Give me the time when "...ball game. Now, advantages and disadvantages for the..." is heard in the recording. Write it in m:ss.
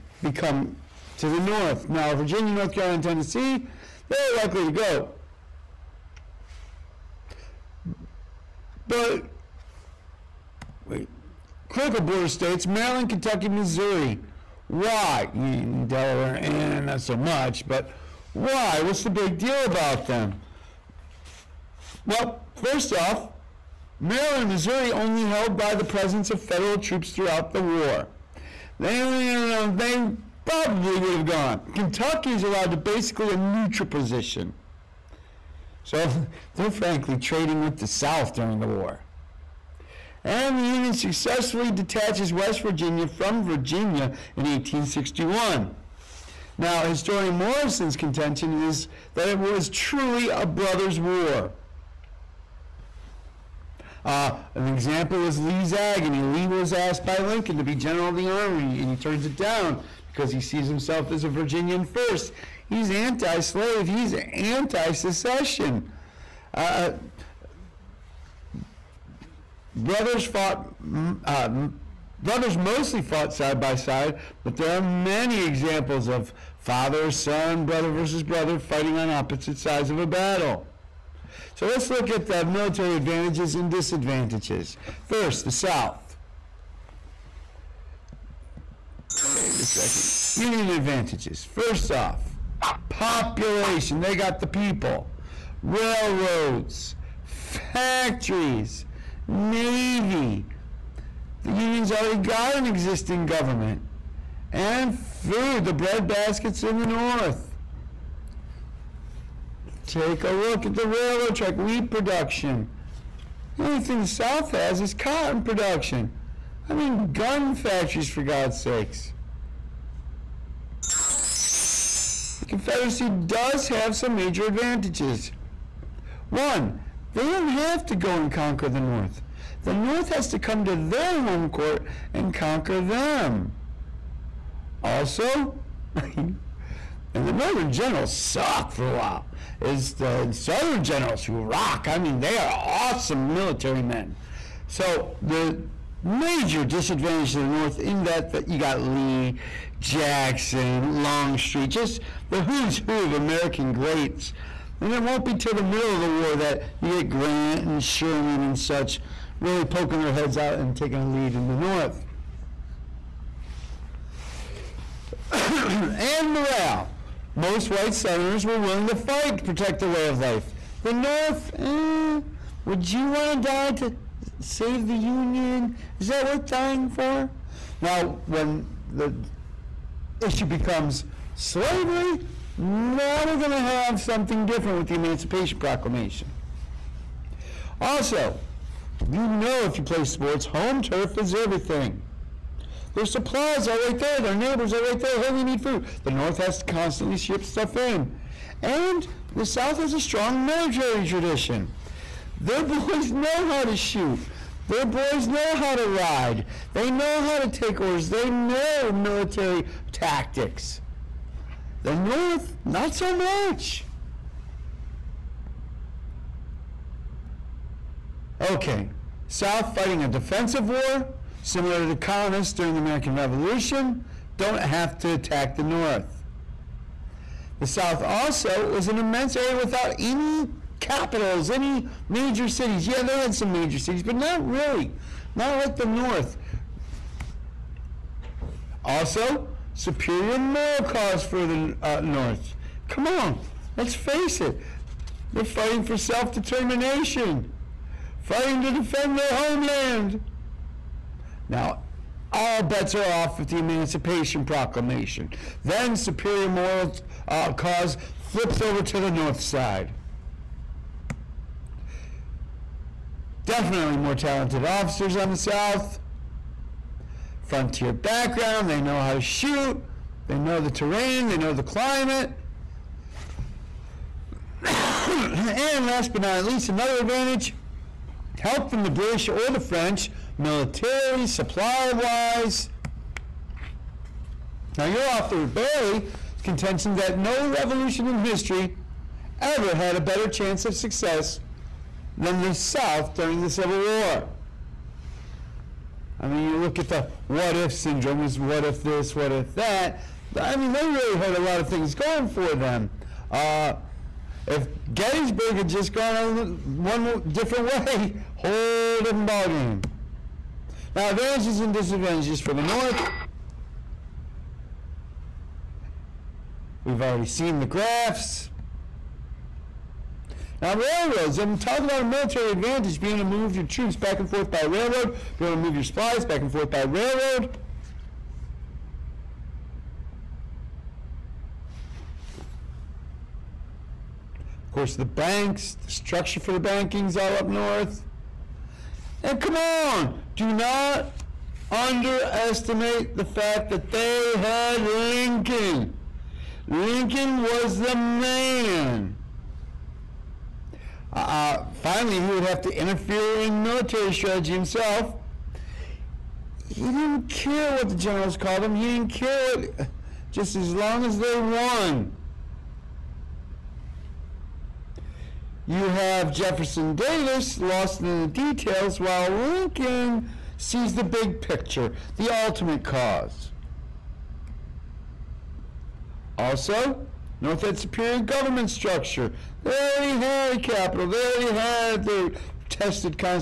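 5:09.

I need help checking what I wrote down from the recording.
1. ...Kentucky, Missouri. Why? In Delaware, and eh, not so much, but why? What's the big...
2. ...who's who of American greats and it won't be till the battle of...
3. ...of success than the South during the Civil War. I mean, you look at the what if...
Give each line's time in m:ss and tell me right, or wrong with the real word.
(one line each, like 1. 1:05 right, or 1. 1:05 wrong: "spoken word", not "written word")
1. 0:13 right
2. 2:32 wrong: "middle", not "battle"
3. 4:50 right.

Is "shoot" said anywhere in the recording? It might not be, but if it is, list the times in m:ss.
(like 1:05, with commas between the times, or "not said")
3:23, 4:29.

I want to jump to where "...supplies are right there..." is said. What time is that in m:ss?
3:13.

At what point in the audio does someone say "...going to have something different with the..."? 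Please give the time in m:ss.
3:03.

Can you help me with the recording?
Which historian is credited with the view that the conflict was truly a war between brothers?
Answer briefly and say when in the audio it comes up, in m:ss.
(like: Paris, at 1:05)
Morison, at 0:47.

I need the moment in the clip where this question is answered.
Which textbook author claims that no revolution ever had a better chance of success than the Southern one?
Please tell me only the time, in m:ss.
4:45.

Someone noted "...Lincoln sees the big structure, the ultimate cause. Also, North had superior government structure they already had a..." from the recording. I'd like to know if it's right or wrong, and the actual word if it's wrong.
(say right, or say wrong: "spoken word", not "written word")
wrong: "picture", not "structure".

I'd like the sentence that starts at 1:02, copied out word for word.
He's anti slave, he's anti secession.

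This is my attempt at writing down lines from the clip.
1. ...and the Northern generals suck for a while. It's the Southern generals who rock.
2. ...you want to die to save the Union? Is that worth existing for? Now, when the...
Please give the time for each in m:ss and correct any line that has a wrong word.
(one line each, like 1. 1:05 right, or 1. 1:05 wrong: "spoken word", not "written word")
1. 2:16 right
2. 2:52 wrong: "dying", not "existing".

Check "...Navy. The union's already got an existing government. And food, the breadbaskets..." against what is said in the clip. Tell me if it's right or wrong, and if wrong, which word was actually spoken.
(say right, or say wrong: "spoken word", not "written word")
right.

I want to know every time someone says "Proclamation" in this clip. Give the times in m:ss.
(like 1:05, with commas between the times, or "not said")
3:05, 4:14.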